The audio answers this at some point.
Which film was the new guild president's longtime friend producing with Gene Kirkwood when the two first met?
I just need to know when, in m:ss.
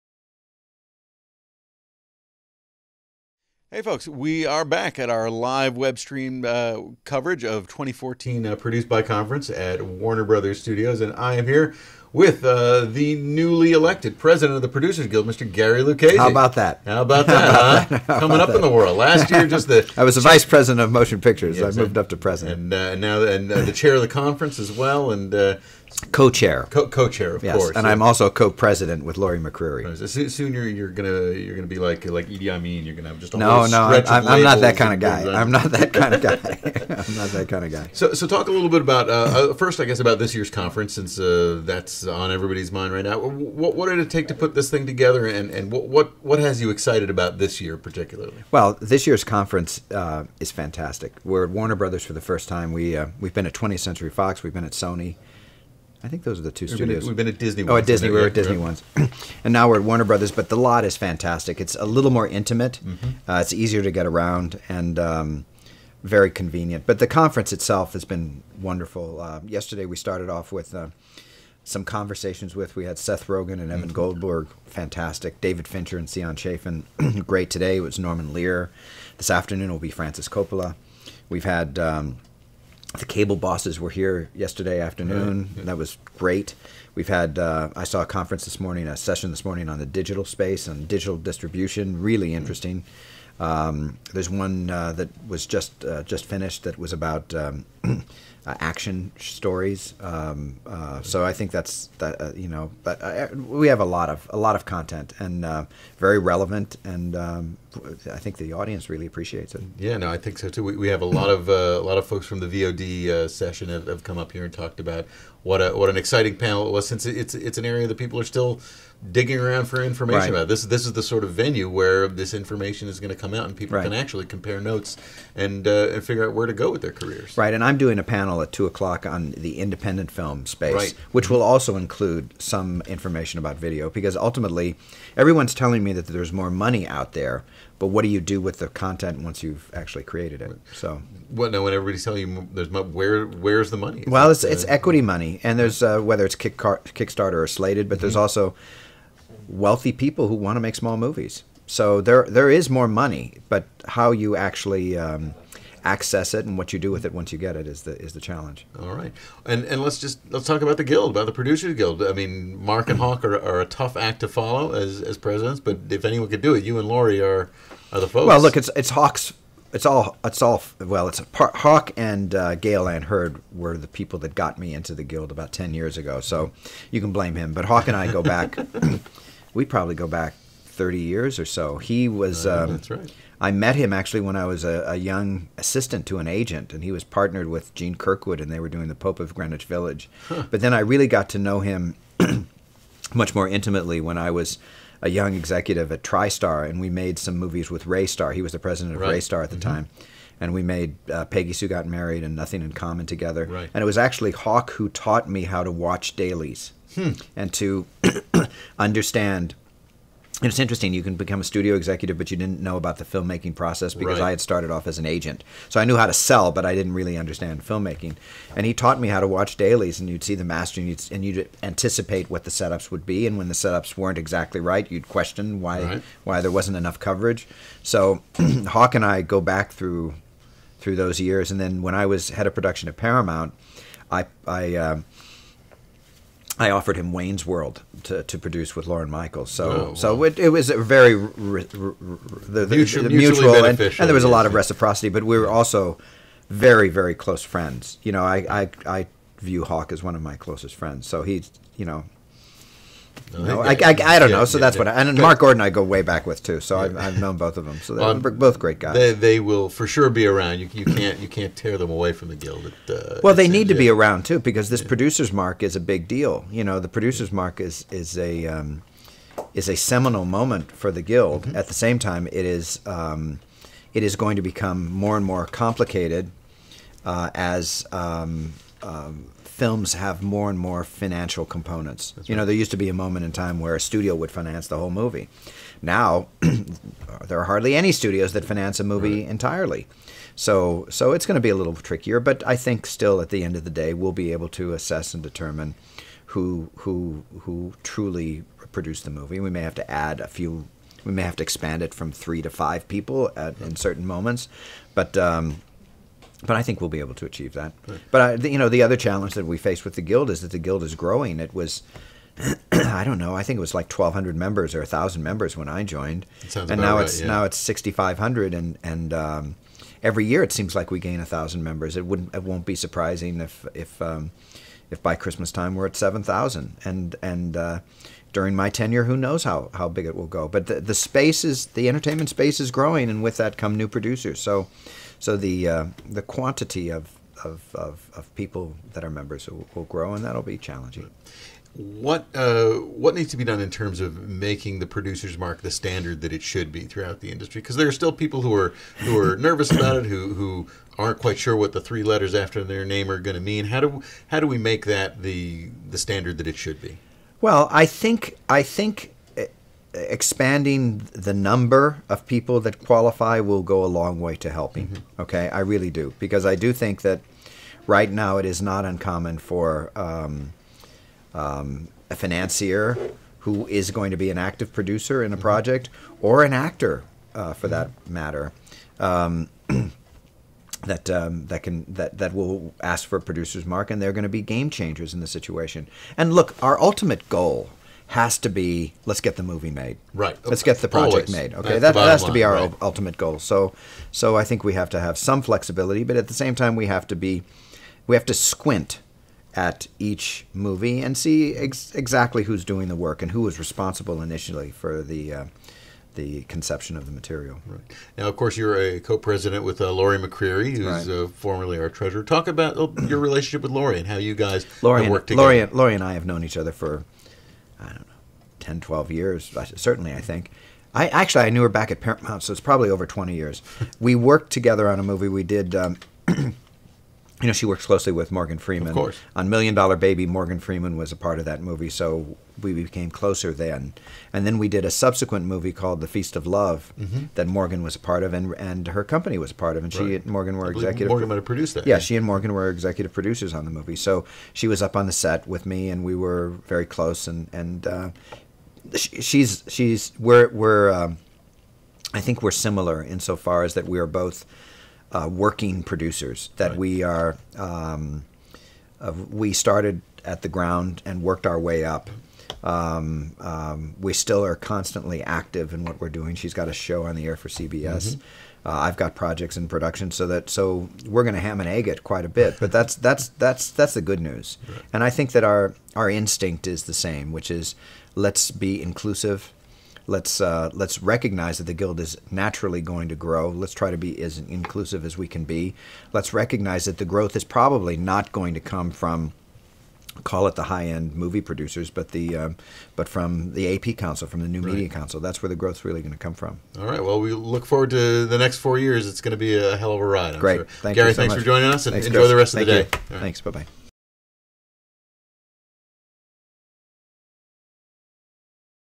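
3:08.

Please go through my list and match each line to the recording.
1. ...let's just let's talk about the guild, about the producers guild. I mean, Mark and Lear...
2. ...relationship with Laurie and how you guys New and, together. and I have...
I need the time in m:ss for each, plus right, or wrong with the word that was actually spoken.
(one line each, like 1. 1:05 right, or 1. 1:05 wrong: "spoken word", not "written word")
1. 2:39 wrong: "Hawk", not "Lear"
2. 6:53 wrong: "Laurie", not "New".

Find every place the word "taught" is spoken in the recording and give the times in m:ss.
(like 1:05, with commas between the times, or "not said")
3:24, 3:38.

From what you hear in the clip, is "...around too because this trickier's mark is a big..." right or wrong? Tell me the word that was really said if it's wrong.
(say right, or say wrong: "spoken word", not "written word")
wrong: "producer", not "trickier".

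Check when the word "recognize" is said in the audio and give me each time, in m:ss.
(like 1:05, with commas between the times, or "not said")
8:01, 8:06.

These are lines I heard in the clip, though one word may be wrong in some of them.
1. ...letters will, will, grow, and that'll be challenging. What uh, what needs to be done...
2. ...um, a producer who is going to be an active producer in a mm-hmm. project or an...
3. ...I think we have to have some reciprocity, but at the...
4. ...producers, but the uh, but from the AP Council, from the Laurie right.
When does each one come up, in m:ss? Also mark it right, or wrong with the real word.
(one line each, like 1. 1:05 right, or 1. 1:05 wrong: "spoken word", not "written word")
1. 5:39 wrong: "members", not "letters"
2. 6:11 wrong: "financier", not "producer"
3. 6:34 wrong: "flexibility", not "reciprocity"
4. 8:11 wrong: "New", not "Laurie".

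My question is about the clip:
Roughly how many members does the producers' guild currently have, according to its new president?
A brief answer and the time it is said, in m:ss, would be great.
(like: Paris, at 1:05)
6,500, at 5:17.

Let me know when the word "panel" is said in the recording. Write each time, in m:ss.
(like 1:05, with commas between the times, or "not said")
1:56, 2:08.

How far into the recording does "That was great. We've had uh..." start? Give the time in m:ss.
1:25.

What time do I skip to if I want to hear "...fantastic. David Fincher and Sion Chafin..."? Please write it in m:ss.
1:14.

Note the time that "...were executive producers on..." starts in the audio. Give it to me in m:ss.
7:22.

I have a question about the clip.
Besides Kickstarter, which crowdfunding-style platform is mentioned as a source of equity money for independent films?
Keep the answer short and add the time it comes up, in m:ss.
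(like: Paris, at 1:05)
Slated, at 2:27.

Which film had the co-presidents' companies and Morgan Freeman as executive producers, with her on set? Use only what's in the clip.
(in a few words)
The Feast of Love.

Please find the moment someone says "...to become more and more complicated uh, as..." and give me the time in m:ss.
4:34.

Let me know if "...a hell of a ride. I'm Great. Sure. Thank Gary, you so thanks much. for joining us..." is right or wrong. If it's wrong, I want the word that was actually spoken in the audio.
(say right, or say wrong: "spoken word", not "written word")
right.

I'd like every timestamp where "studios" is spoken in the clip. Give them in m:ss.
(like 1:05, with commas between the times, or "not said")
0:10, 0:56, 3:31, 4:43, 4:47.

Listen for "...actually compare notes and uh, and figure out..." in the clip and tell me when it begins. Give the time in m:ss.
2:03.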